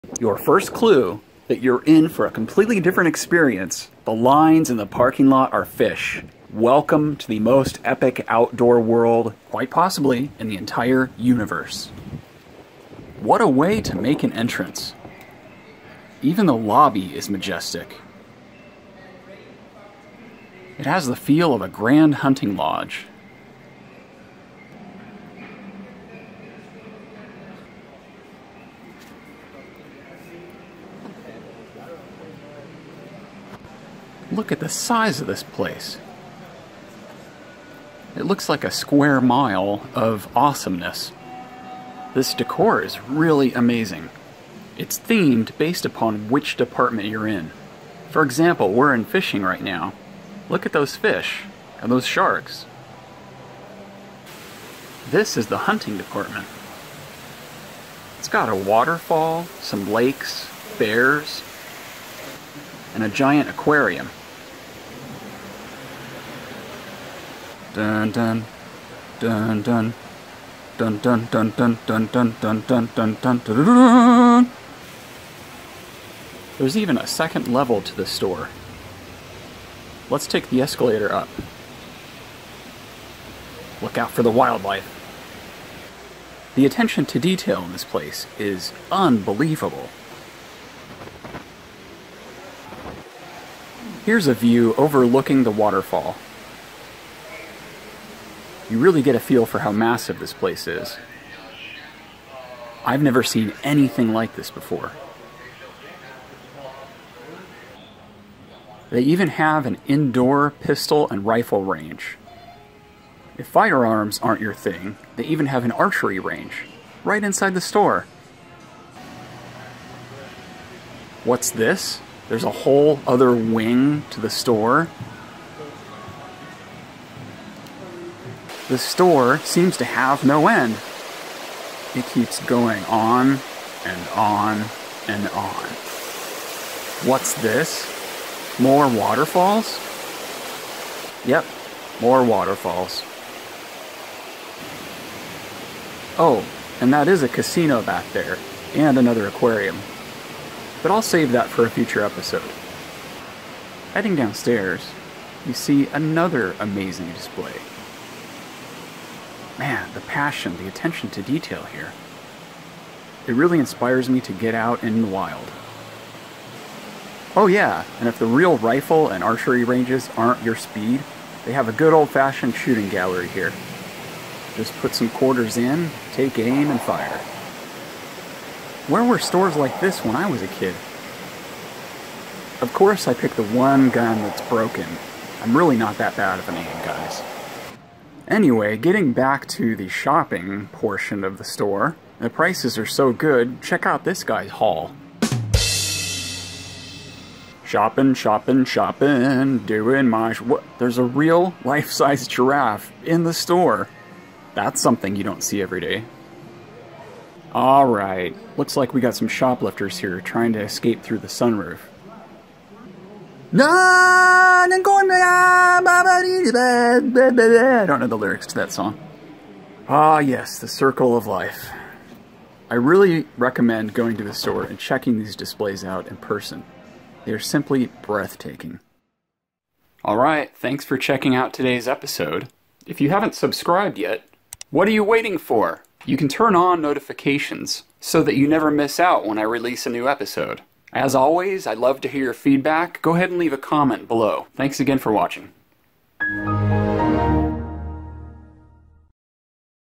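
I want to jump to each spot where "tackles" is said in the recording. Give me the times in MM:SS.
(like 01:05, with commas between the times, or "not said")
not said.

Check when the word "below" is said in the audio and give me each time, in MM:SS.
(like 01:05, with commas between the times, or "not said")
04:04.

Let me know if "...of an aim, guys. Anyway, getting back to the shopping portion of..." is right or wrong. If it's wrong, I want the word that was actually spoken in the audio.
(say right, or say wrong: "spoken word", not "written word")
right.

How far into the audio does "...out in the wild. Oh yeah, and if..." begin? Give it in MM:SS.
02:44.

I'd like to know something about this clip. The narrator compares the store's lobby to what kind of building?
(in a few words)
A grand hunting lodge.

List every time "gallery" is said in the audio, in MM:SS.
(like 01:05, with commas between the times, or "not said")
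02:52.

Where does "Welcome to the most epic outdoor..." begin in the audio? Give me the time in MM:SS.
00:06.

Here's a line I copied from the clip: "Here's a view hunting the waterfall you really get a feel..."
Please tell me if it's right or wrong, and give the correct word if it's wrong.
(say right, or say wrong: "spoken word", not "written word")
wrong: "overlooking", not "hunting".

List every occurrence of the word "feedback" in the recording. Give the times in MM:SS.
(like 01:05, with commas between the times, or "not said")
04:02.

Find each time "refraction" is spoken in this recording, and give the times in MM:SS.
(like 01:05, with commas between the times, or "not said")
not said.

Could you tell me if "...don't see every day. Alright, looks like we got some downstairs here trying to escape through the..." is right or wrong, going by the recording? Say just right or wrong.
wrong.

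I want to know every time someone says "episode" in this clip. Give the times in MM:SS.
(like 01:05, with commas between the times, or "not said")
02:32, 03:51, 04:00.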